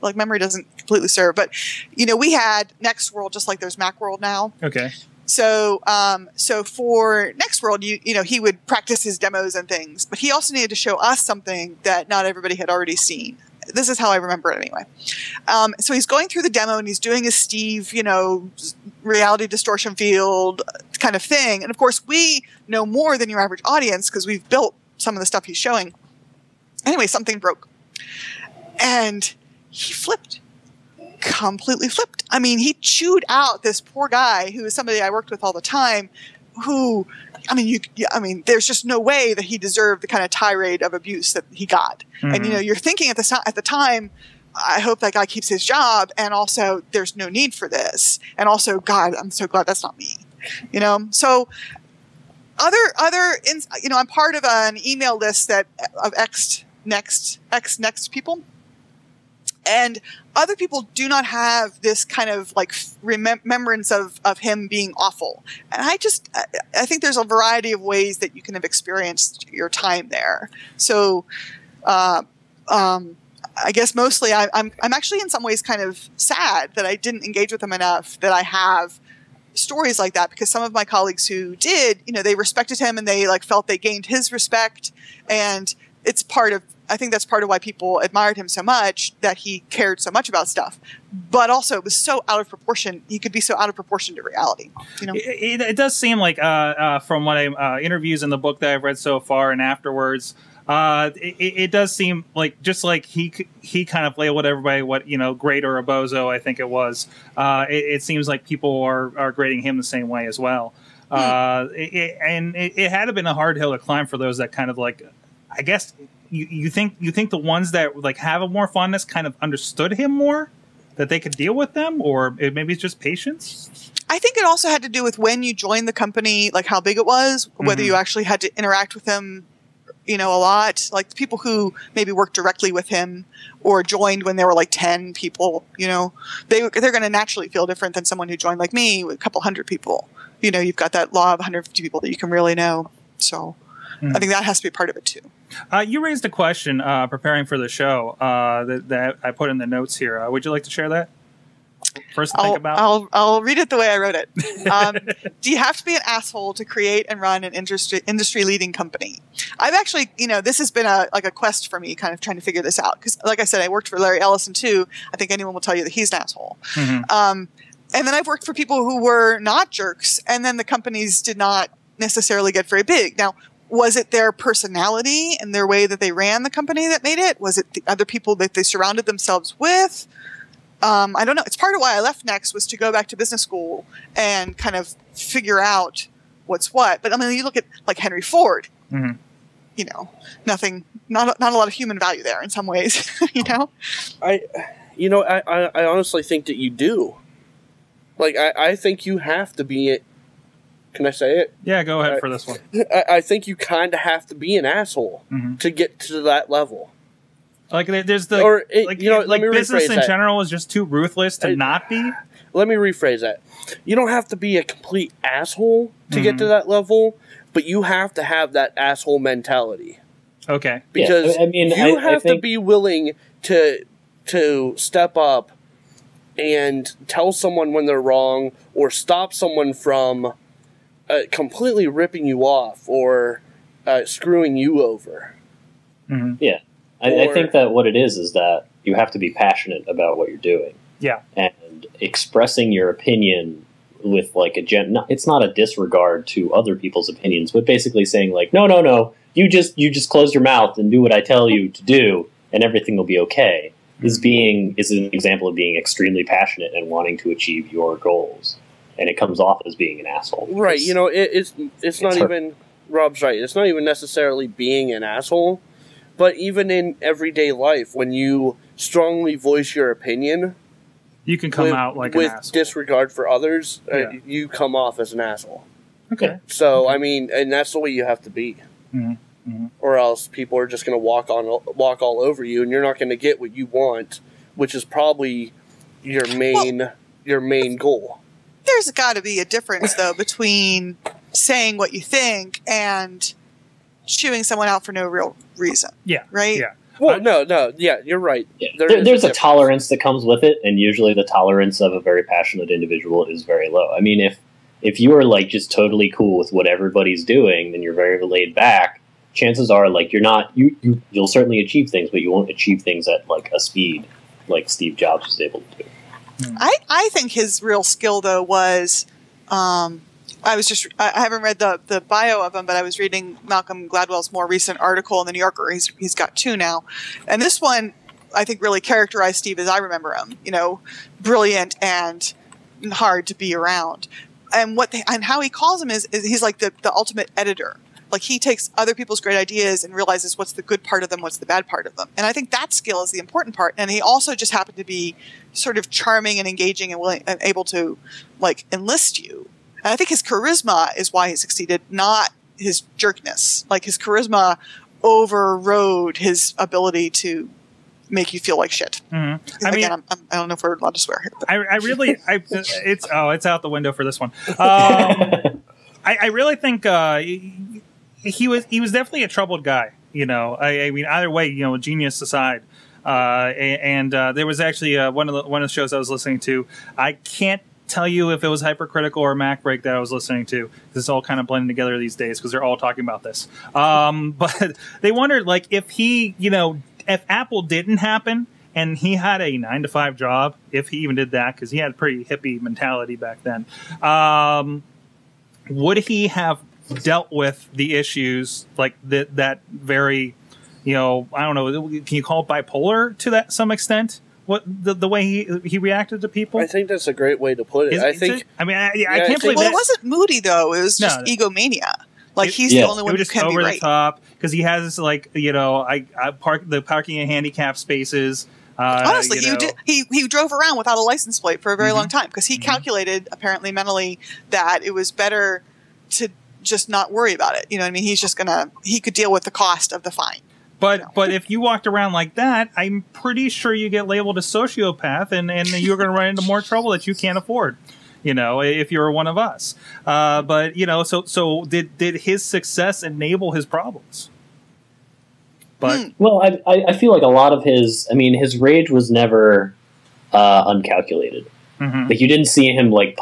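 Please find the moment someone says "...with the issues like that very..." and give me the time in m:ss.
6:37.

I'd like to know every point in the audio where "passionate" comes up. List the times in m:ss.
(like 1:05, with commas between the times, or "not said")
3:59, 4:16, 5:02.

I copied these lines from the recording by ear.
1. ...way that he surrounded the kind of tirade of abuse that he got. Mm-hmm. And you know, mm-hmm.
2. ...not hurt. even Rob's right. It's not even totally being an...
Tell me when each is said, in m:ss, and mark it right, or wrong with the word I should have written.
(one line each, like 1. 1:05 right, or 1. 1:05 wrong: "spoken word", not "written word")
1. 0:38 wrong: "deserved", not "surrounded"
2. 4:22 wrong: "necessarily", not "totally".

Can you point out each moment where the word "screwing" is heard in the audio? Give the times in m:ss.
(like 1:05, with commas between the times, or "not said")
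3:54.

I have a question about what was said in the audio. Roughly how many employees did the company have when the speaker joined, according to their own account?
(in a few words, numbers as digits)
a couple hundred.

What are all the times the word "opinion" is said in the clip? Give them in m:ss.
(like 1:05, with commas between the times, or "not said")
4:02, 4:07, 4:29.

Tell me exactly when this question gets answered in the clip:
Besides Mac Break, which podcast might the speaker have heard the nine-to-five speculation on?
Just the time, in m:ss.
6:18.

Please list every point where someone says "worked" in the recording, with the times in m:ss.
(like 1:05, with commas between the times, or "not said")
0:35, 2:12, 2:43, 2:48.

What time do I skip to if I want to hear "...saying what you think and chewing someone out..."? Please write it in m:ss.
4:51.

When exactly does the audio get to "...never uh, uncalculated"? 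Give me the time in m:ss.
7:29.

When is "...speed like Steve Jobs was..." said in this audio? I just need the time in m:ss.
5:13.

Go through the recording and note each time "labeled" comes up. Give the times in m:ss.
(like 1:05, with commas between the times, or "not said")
1:44, 7:14.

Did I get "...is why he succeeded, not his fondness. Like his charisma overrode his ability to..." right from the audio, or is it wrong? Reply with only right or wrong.
wrong.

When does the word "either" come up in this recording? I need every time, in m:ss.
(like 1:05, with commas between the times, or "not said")
6:11.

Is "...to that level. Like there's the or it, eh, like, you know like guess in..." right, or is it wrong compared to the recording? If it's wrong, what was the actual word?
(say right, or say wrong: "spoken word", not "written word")
wrong: "business", not "guess".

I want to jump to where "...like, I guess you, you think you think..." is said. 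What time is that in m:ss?
1:54.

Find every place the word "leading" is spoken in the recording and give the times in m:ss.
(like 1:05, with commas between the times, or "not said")
2:38.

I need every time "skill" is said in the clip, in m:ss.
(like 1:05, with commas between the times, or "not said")
5:17, 5:42.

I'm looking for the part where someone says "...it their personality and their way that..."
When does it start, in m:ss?
2:53.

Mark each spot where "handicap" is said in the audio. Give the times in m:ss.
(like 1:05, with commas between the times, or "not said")
6:57.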